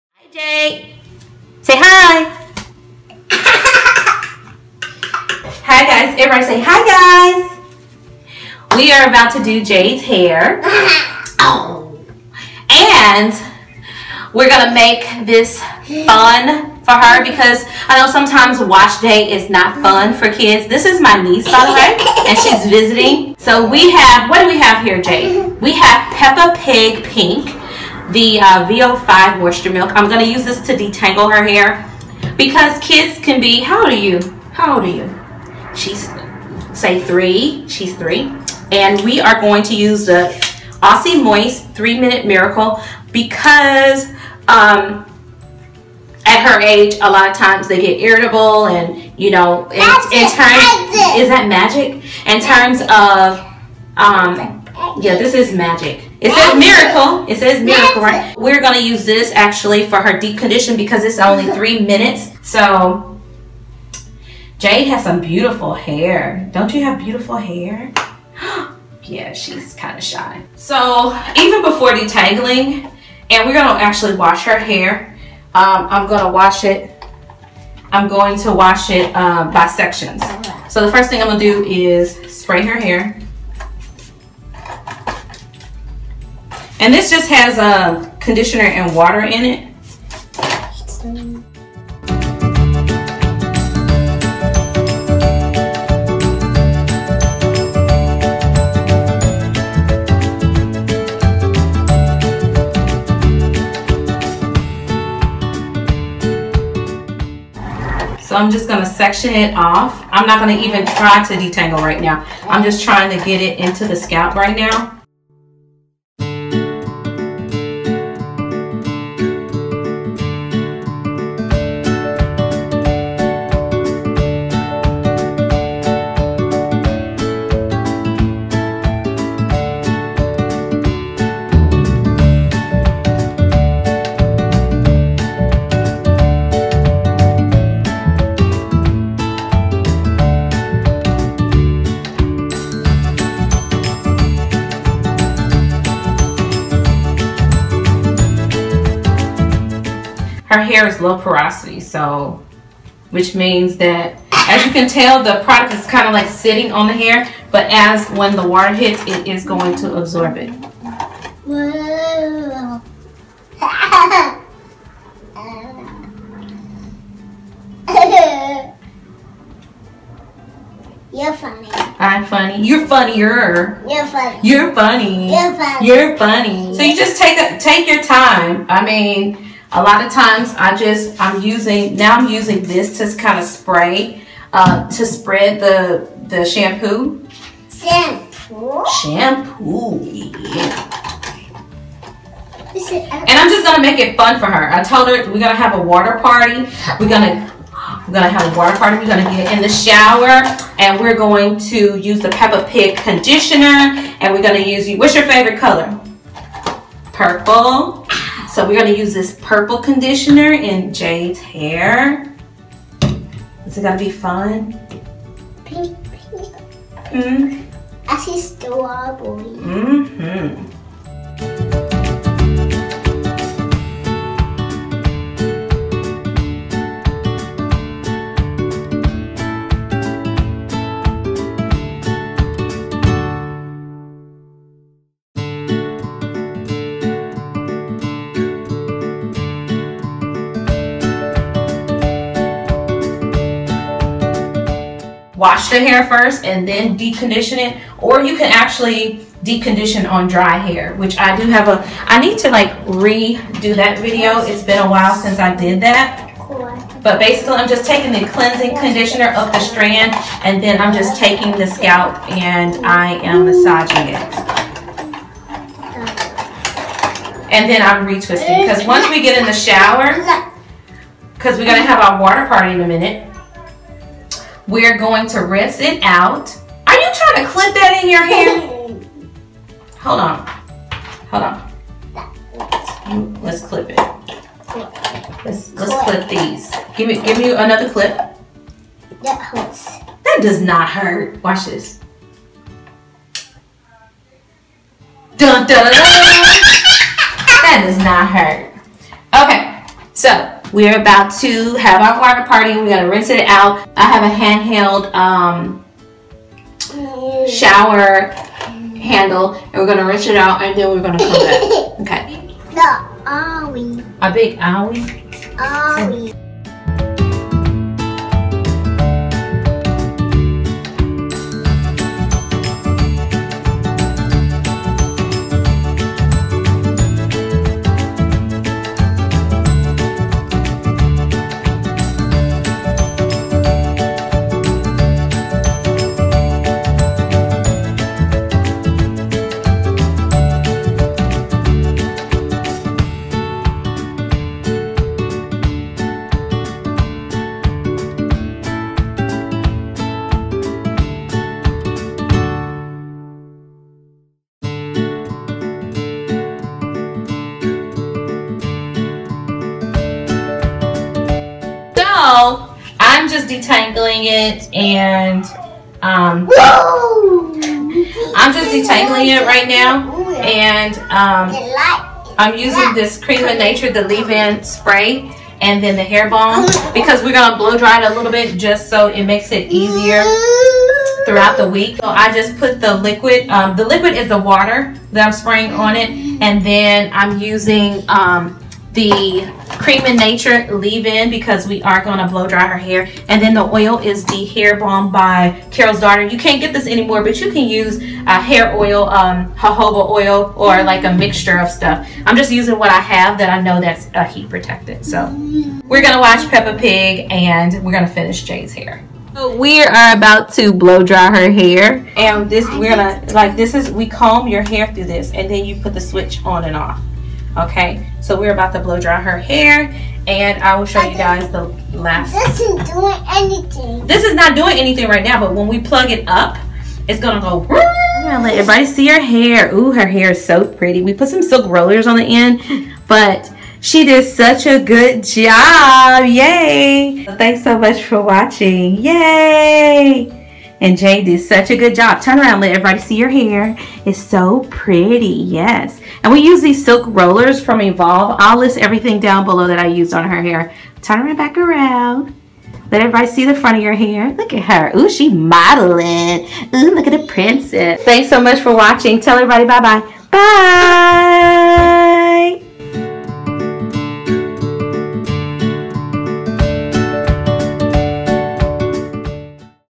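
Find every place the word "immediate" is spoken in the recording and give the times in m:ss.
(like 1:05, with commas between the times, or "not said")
not said.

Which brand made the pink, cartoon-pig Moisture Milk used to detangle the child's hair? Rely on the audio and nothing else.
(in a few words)
VO5.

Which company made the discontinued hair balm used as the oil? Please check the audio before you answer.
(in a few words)
Carol's Daughter.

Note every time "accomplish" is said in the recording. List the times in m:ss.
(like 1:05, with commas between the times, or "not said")
not said.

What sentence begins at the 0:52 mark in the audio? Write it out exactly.
In terms of, um, yeah, this is magic it says miracle.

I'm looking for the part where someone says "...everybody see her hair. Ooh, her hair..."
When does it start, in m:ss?
7:08.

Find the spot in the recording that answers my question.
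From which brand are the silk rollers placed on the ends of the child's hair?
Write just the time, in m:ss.
7:27.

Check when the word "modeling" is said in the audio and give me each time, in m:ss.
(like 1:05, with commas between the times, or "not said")
7:35.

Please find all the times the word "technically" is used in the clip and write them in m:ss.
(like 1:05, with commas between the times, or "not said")
not said.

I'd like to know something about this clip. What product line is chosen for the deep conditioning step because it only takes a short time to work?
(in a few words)
Aussie Moist 3 Minute Miracle.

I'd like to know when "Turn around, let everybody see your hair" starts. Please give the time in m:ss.
7:22.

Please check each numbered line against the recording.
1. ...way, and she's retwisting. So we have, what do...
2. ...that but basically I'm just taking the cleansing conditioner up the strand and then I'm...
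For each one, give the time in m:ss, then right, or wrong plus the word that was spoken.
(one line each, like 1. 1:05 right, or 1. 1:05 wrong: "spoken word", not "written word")
1. 0:21 wrong: "visiting", not "retwisting"
2. 4:15 right.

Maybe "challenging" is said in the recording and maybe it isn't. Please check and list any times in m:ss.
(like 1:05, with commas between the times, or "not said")
not said.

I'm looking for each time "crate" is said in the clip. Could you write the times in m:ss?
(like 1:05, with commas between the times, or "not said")
not said.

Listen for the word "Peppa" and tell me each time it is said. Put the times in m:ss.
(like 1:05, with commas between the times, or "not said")
0:26, 3:22, 6:46.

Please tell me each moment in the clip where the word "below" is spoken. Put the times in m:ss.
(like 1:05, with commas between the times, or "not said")
7:29.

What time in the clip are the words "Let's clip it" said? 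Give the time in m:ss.
4:43.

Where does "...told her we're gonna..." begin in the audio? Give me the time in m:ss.
3:14.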